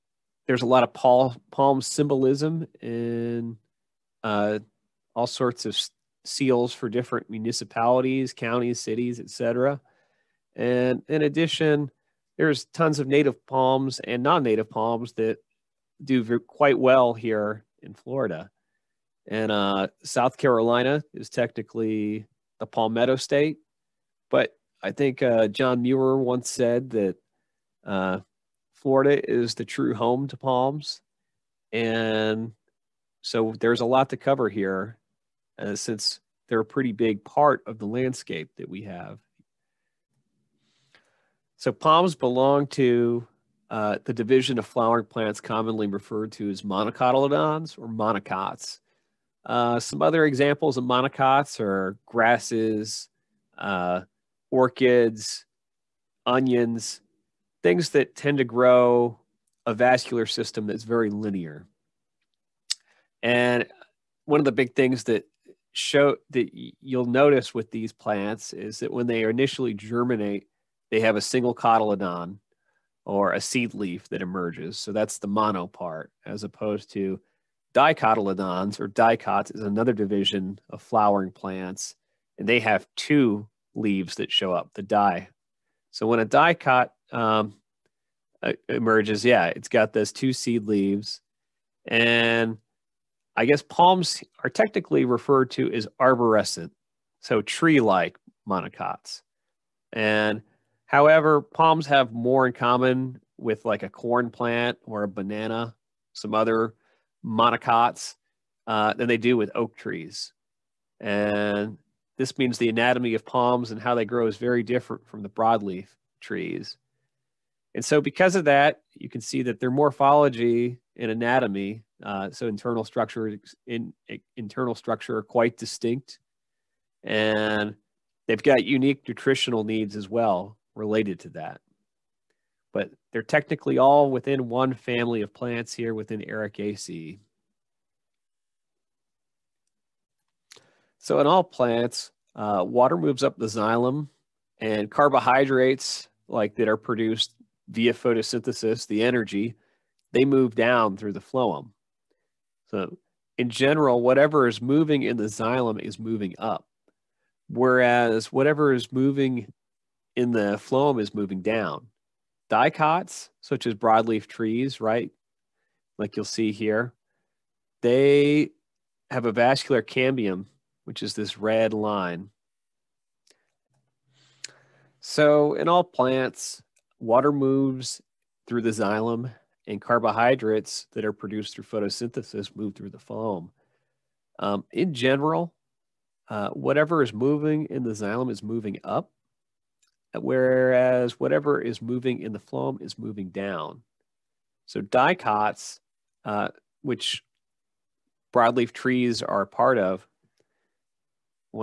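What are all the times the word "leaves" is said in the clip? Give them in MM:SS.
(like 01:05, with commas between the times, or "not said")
01:23, 01:30.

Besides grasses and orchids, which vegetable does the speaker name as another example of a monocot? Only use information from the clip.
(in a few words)
Onions.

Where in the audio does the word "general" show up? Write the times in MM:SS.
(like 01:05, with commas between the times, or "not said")
02:33, 03:04.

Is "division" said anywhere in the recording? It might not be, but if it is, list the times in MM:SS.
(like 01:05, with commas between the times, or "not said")
00:44, 01:19.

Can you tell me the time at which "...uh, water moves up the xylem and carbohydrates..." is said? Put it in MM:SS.
02:22.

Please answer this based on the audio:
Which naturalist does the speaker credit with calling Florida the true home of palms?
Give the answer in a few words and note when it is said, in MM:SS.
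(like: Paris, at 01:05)
John Muir, at 00:25.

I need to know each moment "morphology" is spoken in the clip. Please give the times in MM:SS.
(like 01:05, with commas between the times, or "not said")
01:59.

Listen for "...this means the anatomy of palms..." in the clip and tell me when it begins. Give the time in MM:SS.
01:52.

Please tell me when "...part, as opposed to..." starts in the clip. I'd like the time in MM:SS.
01:15.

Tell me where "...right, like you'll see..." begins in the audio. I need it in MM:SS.
02:44.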